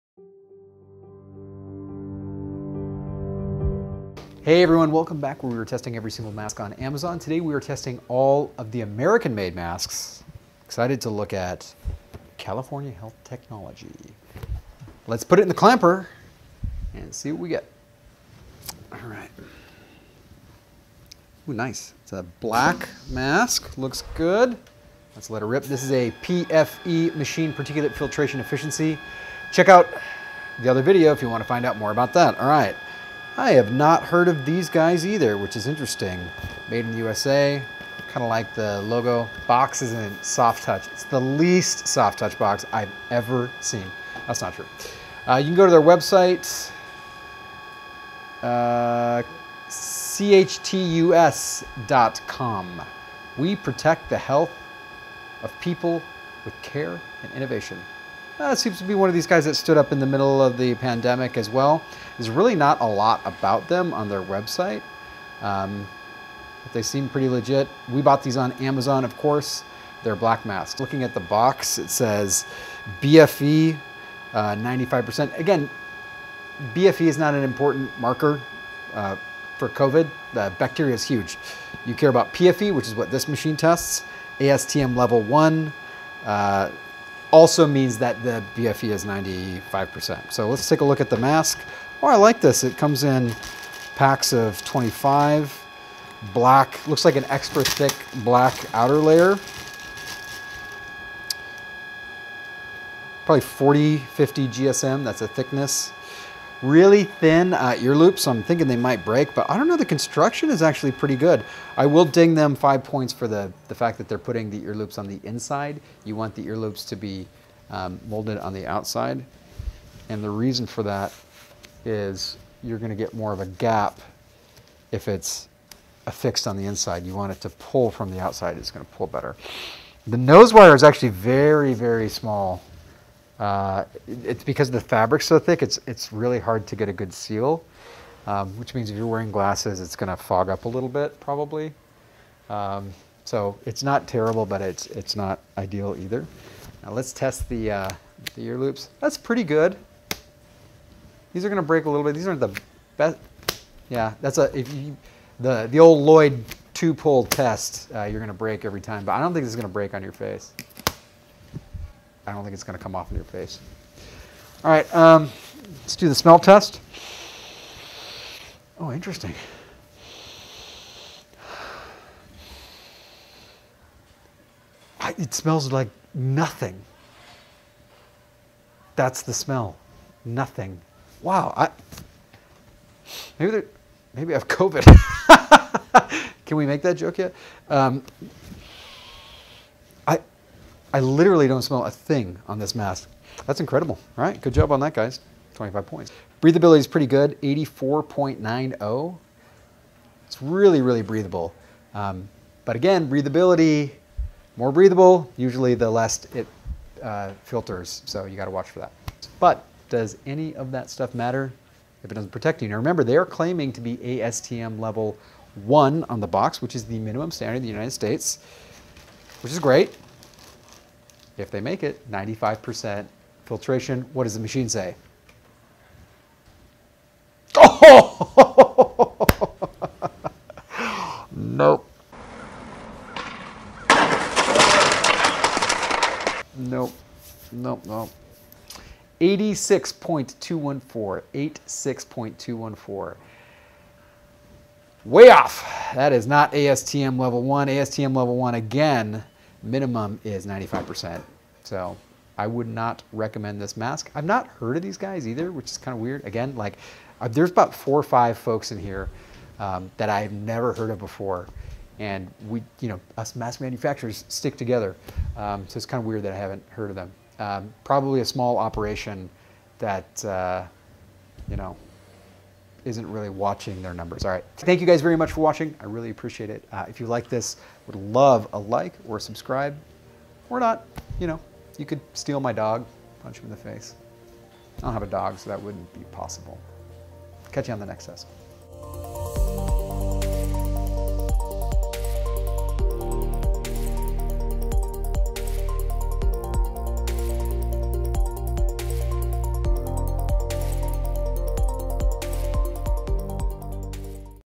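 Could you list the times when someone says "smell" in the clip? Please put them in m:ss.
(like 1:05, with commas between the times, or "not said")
2:46, 2:55, 2:59, 3:11.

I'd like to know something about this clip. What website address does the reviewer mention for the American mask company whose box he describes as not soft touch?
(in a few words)
chtus.com.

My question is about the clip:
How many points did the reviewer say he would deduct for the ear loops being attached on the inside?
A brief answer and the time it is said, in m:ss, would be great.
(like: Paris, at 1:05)
5, at 1:52.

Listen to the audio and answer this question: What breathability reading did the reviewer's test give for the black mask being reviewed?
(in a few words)
84.90.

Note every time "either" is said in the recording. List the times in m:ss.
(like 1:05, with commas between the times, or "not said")
0:35, 2:25, 4:15.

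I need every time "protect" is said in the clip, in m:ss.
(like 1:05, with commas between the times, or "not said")
0:53, 3:32.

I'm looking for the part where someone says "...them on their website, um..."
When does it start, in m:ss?
1:03.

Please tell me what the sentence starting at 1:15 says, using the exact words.
Uh, Again, BFE is not an important marker uh, for COVID.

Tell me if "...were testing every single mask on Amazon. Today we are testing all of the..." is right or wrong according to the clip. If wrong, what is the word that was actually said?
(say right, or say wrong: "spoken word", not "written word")
right.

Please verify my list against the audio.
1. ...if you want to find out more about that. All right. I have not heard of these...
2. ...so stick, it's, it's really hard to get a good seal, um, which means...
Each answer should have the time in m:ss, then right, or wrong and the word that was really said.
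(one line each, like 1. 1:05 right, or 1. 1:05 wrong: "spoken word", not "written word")
1. 0:31 right
2. 2:15 wrong: "thick", not "stick".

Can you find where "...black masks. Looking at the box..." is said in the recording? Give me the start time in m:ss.
1:10.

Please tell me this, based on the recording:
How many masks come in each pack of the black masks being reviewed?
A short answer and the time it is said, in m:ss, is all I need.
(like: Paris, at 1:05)
25, at 1:33.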